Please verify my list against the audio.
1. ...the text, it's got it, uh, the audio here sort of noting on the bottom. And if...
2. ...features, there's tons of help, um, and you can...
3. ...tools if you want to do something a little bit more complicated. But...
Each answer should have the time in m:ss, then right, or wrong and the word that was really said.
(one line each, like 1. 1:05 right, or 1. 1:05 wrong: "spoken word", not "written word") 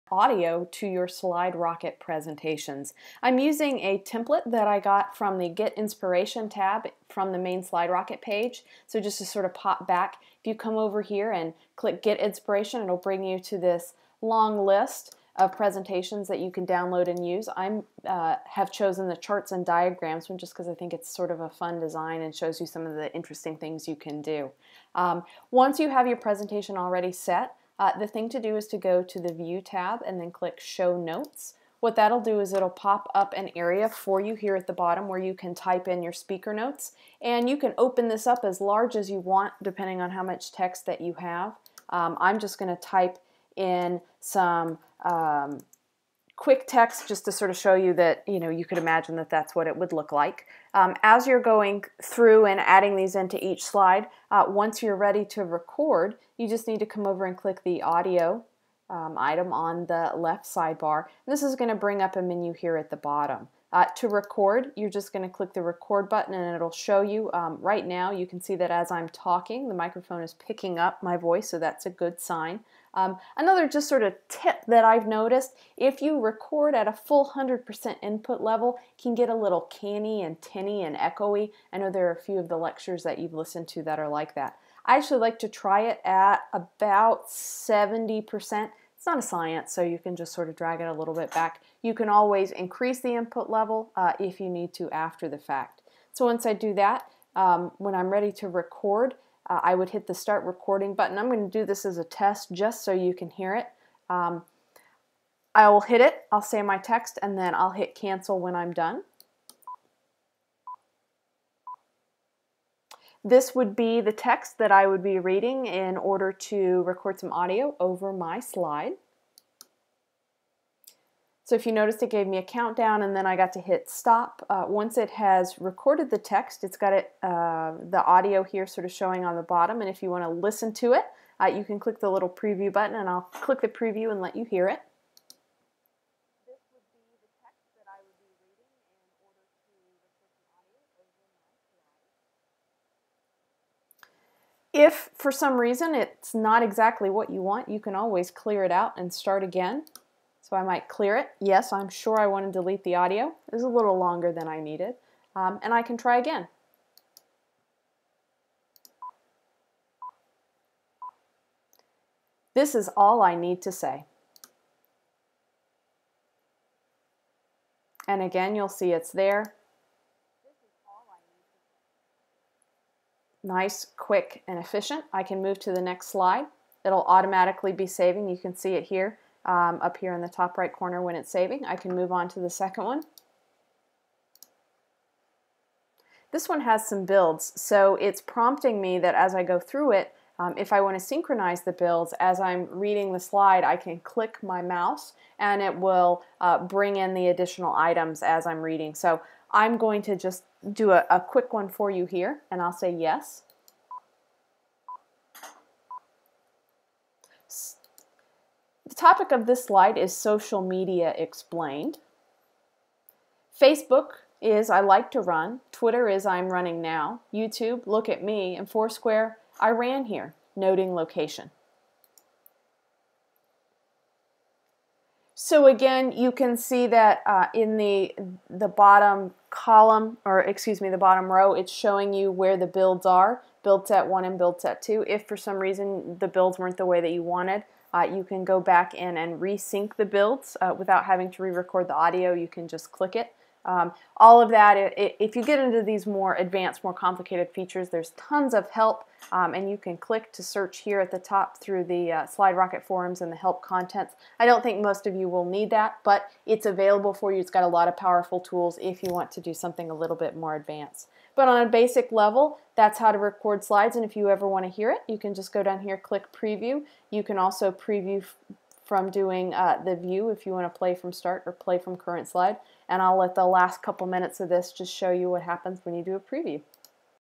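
1. 2:06 wrong: "showing", not "noting"
2. 4:07 right
3. 4:18 wrong: "advanced", not "complicated".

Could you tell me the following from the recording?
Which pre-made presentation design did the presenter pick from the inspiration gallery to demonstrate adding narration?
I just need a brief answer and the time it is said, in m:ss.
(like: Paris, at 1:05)
charts and diagrams, at 0:19.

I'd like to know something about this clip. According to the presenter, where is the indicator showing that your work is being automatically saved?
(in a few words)
top right corner.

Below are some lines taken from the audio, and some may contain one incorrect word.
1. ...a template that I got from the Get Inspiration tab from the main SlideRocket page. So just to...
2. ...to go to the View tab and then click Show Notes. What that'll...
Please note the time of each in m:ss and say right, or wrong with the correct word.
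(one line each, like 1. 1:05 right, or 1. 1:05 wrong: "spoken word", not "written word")
1. 0:03 right
2. 0:28 right.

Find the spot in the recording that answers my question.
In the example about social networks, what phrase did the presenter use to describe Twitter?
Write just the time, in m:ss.
3:36.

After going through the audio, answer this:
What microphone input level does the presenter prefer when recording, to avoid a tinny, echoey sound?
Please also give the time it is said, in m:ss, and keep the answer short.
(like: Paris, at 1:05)
70%, at 1:27.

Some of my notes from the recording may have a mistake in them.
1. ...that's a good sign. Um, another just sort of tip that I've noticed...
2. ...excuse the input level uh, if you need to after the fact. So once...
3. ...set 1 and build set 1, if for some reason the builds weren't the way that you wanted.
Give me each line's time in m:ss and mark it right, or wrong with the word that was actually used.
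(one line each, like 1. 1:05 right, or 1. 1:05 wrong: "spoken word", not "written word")
1. 1:11 right
2. 1:32 wrong: "increase", not "excuse"
3. 3:53 wrong: "2", not "1".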